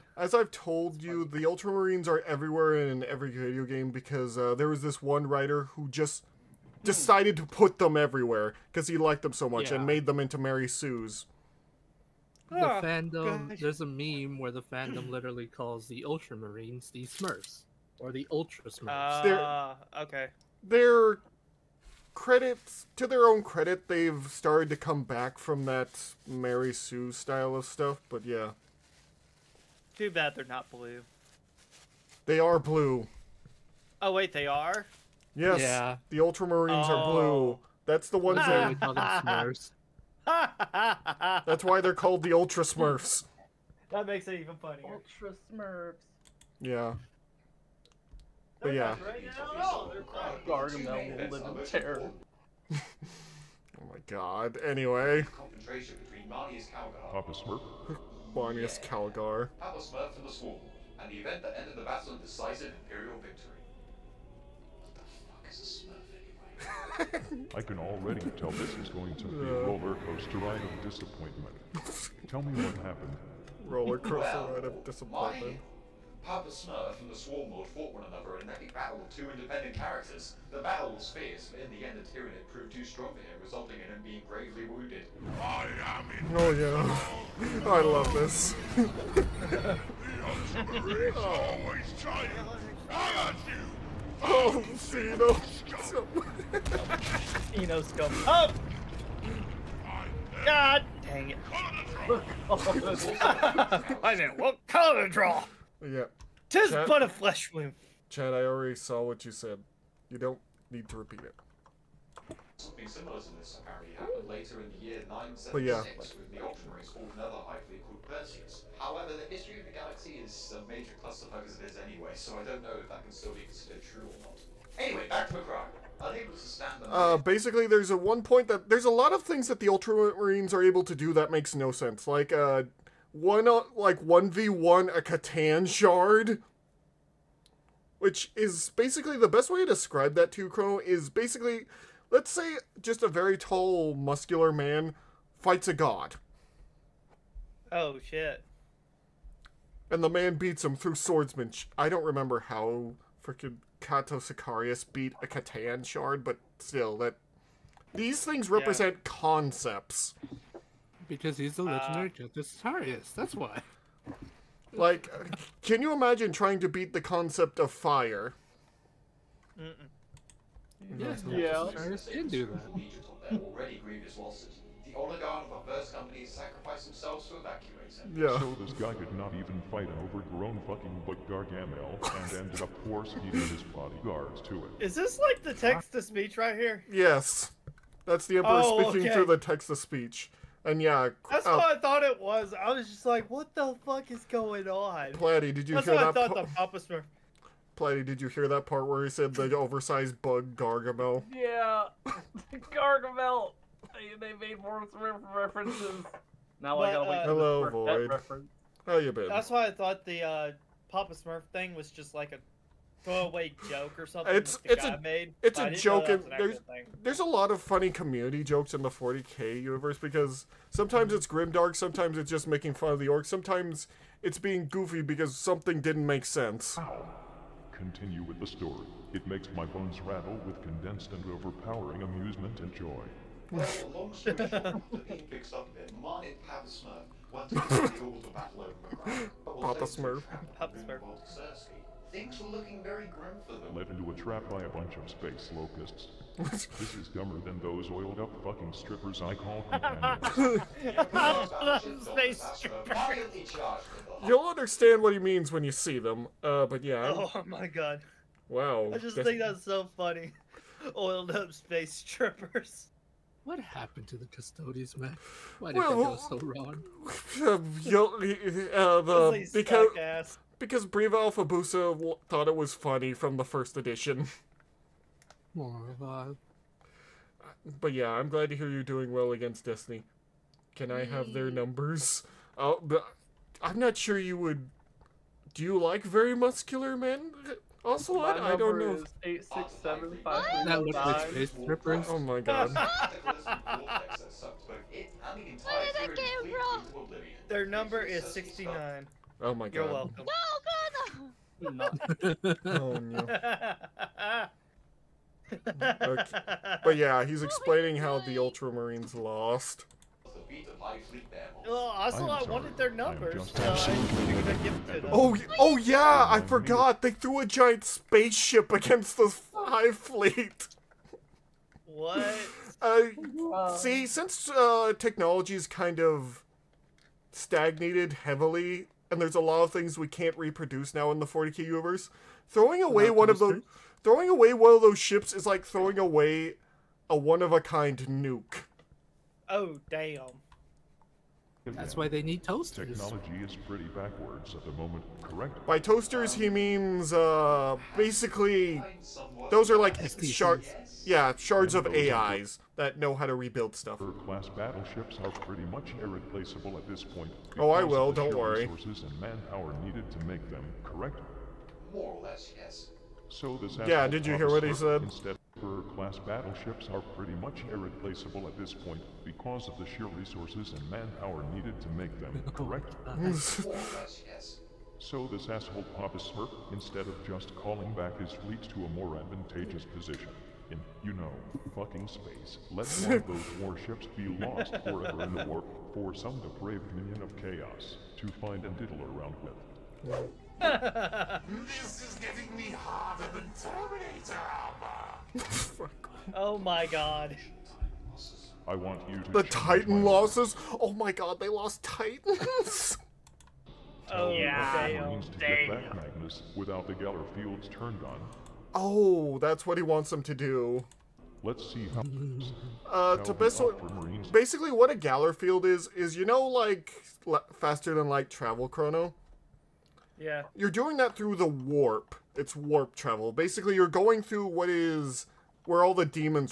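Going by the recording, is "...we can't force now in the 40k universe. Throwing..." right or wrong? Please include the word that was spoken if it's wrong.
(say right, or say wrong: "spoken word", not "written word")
wrong: "reproduce", not "force".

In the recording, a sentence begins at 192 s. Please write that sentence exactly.
I was just like, "What the fuck is going on?" Platty, did you that's hear that?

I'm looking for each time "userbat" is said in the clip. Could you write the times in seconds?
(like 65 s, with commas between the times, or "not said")
not said.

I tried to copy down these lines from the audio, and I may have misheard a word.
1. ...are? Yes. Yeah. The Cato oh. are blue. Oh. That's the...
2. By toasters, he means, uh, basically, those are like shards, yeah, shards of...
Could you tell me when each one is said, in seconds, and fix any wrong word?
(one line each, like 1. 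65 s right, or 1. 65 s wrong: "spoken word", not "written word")
1. 34 s wrong: "Ultramarines", not "Cato"
2. 345 s right.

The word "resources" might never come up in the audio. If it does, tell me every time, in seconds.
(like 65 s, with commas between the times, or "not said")
358 s, 370 s.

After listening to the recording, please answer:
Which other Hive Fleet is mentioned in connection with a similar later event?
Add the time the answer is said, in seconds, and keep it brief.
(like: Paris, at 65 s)
Perseus, at 118 s.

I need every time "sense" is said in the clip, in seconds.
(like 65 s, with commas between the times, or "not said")
131 s, 226 s.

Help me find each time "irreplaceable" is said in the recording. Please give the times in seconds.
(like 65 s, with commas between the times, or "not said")
356 s, 367 s.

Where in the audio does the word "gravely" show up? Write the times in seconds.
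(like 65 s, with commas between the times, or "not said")
84 s.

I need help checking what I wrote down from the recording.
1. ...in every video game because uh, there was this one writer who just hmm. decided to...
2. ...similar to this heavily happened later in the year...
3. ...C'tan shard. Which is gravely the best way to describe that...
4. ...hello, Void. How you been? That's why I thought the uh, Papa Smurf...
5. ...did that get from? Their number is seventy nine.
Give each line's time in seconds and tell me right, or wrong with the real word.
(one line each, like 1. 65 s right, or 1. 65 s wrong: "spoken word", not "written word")
1. 2 s right
2. 112 s wrong: "apparently", not "heavily"
3. 135 s wrong: "basically", not "gravely"
4. 207 s right
5. 295 s wrong: "sixty", not "seventy".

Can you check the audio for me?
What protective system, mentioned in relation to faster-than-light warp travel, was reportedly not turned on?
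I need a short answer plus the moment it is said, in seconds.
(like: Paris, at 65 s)
Geller fields, at 406 s.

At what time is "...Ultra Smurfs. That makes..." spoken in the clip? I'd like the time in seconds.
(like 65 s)
42 s.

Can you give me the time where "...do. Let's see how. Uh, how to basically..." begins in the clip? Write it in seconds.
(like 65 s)
410 s.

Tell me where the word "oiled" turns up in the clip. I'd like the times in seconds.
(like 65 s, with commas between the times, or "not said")
247 s, 260 s.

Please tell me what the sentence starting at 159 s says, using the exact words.
concepts because he's the legendary uh, Justice That's why.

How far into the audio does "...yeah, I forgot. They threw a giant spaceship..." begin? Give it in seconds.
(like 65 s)
315 s.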